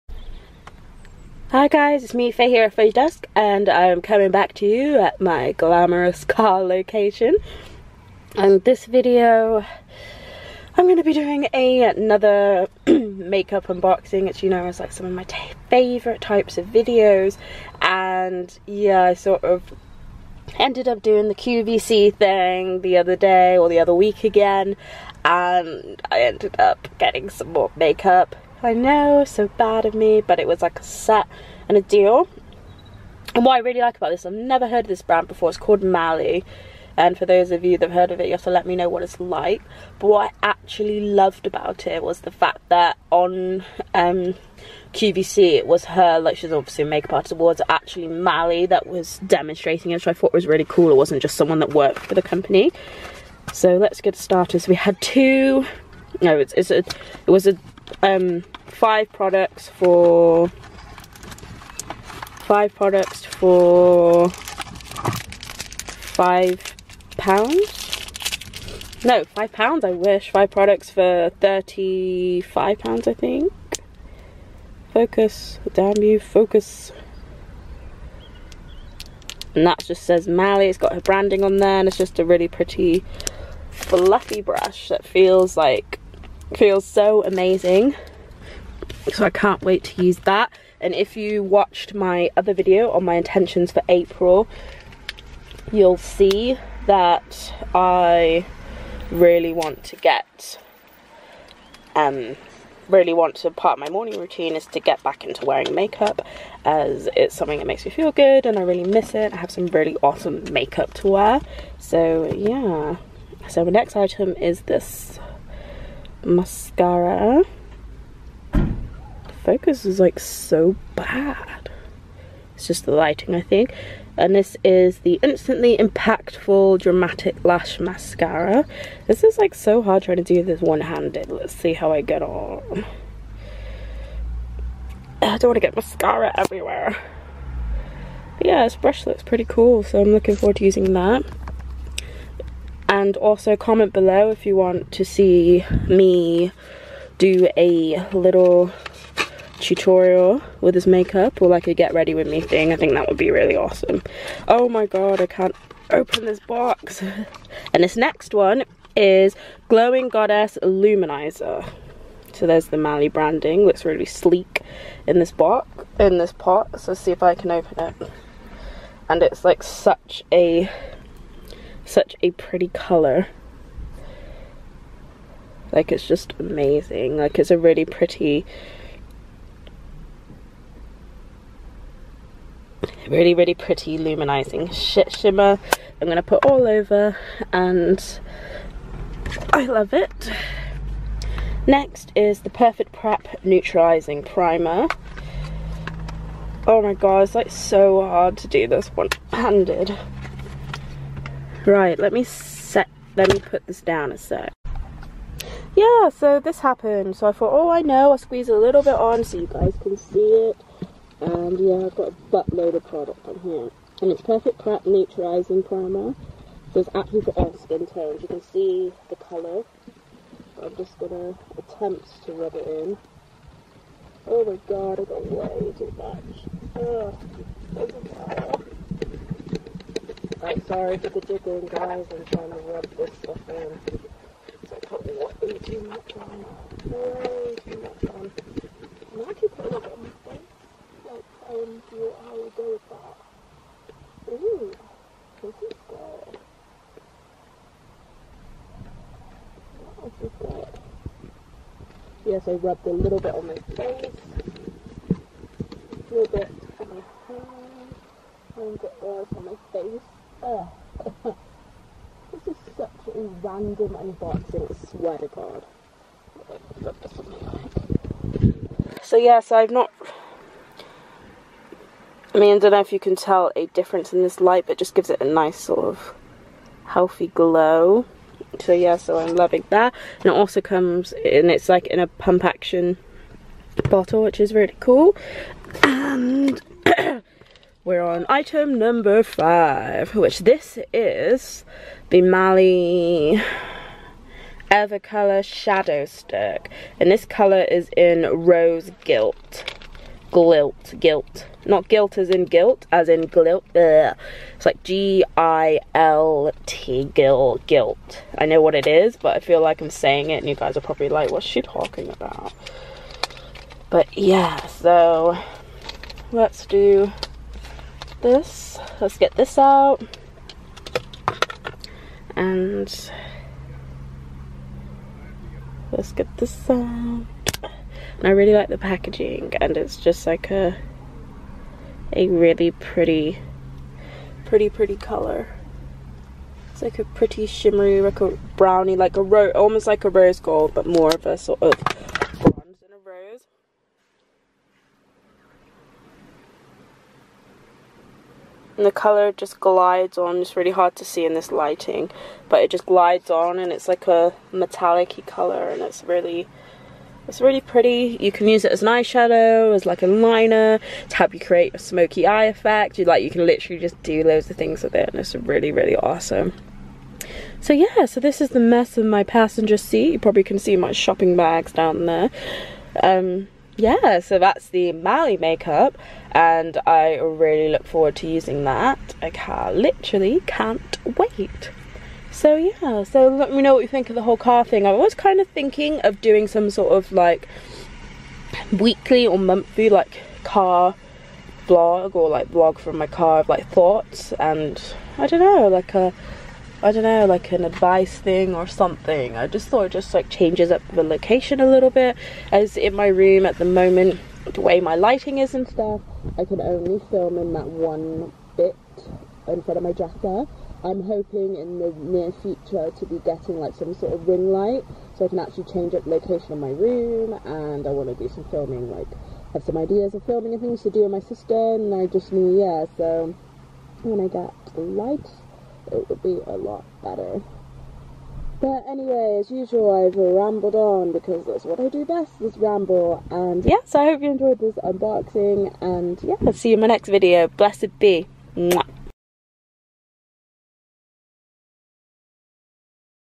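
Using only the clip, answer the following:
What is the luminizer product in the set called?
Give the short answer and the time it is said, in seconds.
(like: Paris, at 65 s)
Glowing Goddess, at 159 s.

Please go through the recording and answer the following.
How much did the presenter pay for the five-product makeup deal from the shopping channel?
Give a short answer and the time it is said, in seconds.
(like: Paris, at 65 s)
35 pounds, at 71 s.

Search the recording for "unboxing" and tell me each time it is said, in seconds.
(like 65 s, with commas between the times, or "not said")
13 s, 263 s, 434 s.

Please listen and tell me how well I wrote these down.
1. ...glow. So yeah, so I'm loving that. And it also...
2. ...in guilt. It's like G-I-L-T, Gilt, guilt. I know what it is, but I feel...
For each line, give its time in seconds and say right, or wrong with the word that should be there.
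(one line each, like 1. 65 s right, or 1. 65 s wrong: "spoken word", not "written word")
1. 277 s right
2. 303 s right.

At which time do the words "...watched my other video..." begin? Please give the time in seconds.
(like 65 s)
91 s.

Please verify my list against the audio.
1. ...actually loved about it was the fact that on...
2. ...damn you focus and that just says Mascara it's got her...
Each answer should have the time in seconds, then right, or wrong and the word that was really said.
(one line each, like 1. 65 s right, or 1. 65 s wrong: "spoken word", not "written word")
1. 40 s right
2. 75 s wrong: "Mally", not "Mascara".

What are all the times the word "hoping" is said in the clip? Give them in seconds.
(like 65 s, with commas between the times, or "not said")
411 s.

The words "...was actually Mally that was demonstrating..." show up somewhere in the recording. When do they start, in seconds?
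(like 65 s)
47 s.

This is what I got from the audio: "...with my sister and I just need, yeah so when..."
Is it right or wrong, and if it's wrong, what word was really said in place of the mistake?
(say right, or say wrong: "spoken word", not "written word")
right.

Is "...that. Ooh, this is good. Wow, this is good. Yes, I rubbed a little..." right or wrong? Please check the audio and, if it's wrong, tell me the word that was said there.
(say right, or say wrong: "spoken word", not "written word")
right.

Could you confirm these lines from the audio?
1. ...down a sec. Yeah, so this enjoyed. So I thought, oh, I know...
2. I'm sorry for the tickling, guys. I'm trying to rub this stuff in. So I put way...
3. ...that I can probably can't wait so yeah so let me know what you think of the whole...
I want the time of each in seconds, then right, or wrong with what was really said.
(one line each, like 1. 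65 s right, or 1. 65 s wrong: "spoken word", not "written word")
1. 203 s wrong: "happened", not "enjoyed"
2. 230 s right
3. 378 s wrong: "literally", not "probably".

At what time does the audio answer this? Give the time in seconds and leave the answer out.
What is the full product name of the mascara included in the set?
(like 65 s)
125 s.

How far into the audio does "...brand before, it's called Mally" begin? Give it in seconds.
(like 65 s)
35 s.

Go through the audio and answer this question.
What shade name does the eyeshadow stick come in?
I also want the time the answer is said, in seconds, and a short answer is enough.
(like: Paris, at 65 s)
Rose Gilt, at 298 s.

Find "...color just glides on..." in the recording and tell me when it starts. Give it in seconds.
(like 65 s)
348 s.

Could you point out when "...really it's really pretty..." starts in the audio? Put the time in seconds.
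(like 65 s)
356 s.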